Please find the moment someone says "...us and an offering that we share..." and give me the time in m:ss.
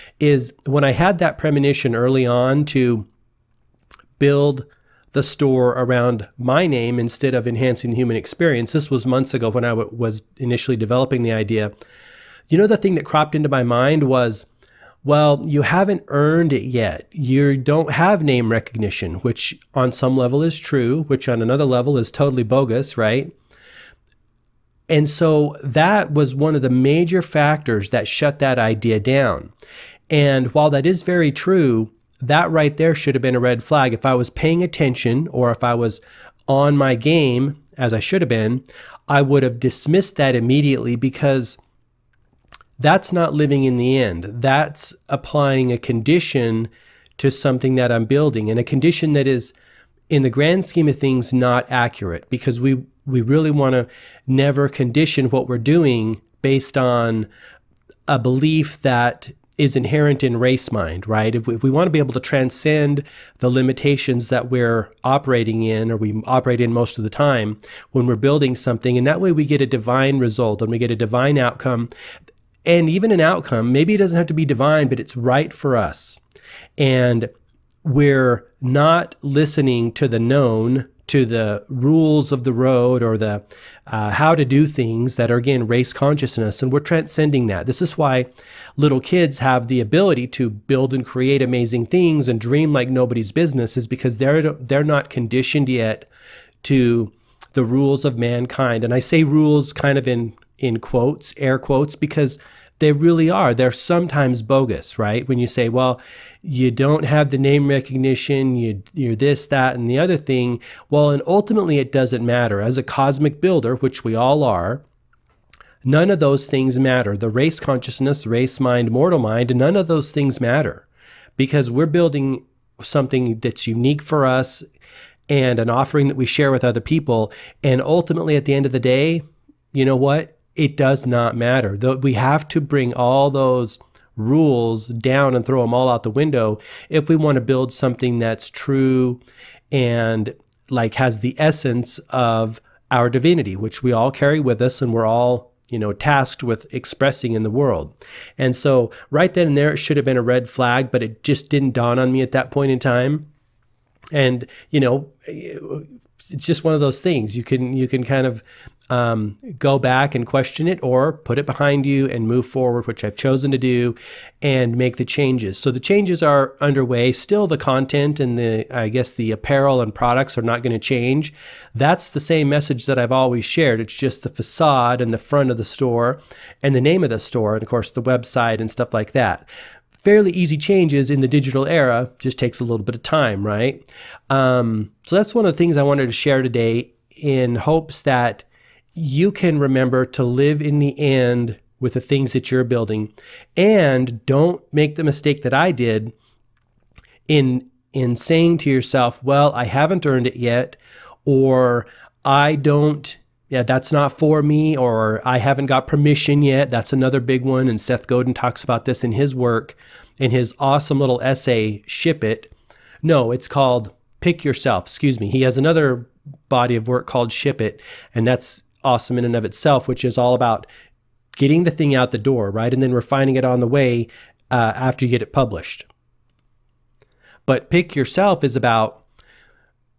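2:04.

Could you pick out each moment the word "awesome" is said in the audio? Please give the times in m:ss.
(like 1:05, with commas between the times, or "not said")
3:30, 3:38.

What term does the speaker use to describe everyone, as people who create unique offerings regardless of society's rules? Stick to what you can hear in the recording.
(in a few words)
Cosmic builder.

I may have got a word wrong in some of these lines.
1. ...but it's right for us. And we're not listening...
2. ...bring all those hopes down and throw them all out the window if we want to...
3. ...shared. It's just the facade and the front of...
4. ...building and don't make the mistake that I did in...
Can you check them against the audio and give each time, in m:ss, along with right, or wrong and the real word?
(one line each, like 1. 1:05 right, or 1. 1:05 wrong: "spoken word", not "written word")
1. 1:14 right
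2. 2:12 wrong: "rules", not "hopes"
3. 2:53 right
4. 3:12 right.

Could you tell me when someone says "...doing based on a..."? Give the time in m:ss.
0:55.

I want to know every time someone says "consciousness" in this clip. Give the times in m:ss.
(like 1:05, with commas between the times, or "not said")
1:25, 1:57.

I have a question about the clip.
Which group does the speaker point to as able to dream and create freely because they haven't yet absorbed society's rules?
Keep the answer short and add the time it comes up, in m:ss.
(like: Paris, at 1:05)
Little kids, at 1:28.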